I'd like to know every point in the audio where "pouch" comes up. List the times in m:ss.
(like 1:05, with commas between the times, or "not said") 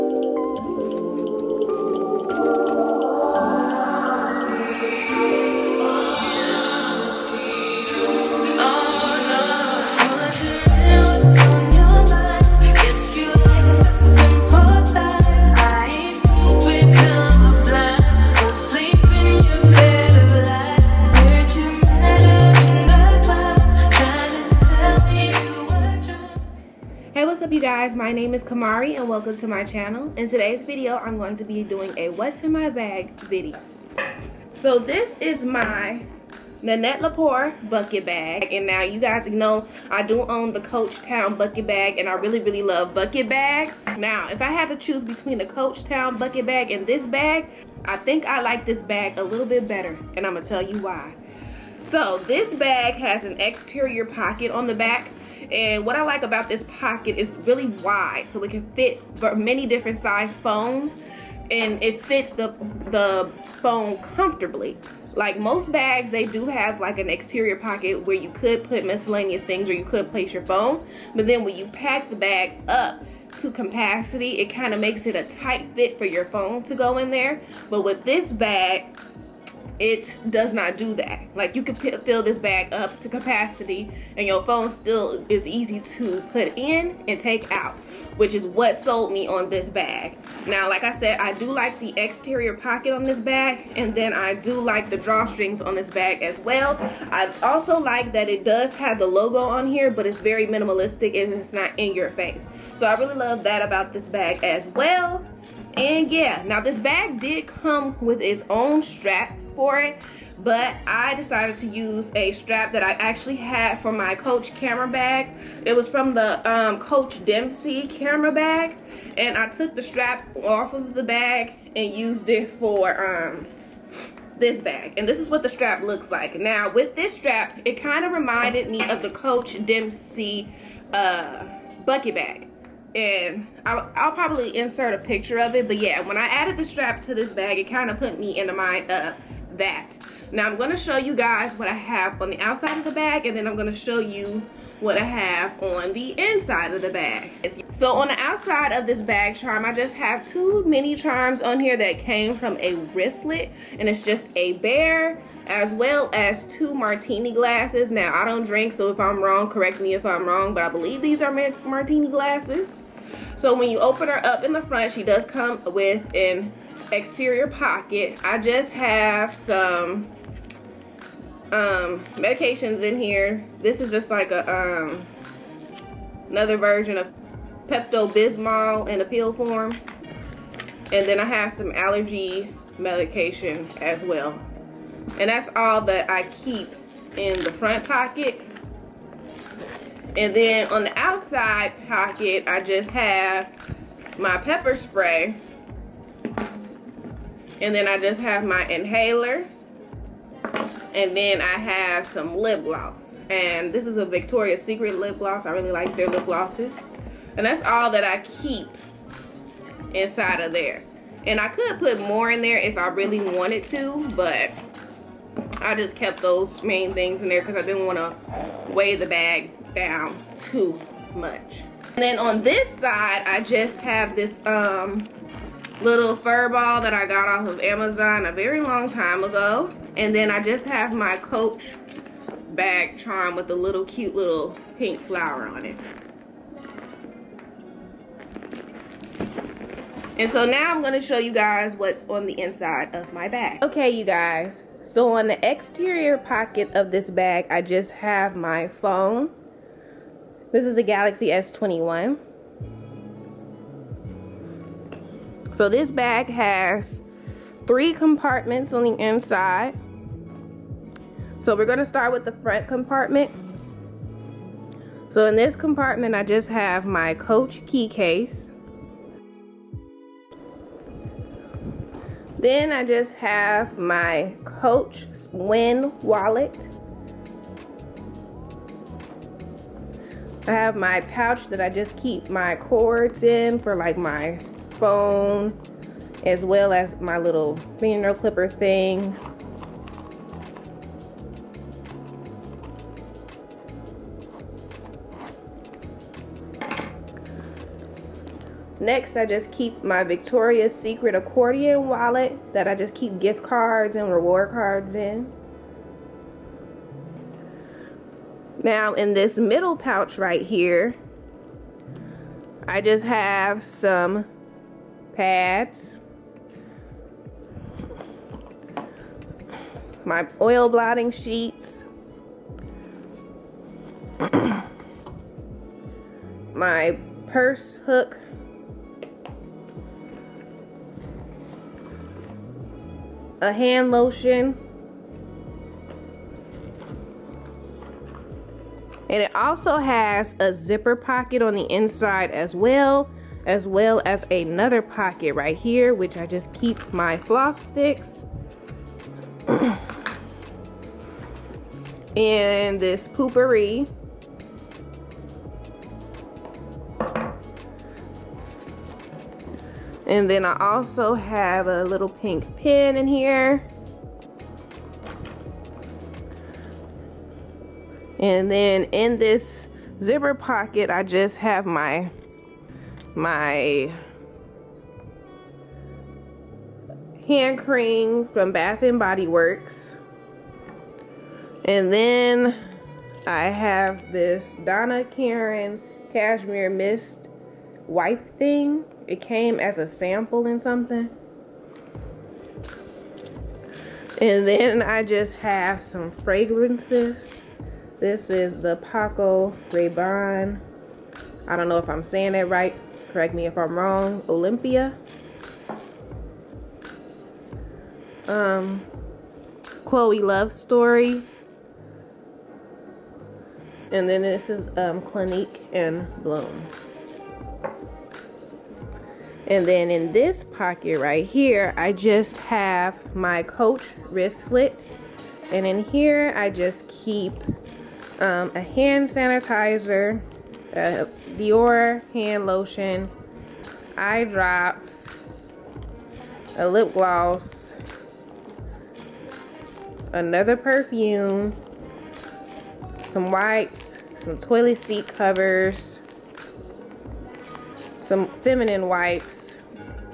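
4:40, 5:09.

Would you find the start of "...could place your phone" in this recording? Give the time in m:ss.
1:09.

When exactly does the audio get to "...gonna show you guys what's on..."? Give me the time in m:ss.
4:00.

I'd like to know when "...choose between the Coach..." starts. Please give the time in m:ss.
0:44.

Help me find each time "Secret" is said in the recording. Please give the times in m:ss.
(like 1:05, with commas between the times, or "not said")
3:24, 5:00.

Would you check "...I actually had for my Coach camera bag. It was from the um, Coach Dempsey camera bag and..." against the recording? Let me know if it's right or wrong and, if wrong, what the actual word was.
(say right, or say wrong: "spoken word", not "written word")
right.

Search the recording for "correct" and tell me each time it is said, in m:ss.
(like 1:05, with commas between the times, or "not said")
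2:39, 6:43.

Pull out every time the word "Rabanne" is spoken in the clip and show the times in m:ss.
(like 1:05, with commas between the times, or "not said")
6:39.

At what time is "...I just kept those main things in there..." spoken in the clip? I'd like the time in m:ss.
3:35.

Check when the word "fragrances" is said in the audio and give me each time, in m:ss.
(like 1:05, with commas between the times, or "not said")
6:36.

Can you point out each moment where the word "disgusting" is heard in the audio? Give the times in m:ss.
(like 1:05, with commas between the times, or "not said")
not said.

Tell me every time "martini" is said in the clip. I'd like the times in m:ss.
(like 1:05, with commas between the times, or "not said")
2:36, 2:41.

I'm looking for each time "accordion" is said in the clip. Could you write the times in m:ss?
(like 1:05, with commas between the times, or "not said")
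5:01.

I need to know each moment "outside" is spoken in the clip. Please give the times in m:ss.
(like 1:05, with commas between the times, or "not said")
2:22, 2:28, 3:10.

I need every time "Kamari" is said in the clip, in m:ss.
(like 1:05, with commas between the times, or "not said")
0:28.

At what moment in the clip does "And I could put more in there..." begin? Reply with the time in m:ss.
3:31.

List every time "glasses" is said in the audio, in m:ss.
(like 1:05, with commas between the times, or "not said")
2:37, 2:42.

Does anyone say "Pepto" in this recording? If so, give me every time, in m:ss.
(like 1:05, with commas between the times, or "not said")
2:57.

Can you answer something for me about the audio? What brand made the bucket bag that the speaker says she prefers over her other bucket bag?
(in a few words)
Nanette Lepore.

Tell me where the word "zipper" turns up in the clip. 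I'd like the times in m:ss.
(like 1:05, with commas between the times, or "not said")
5:40, 6:10.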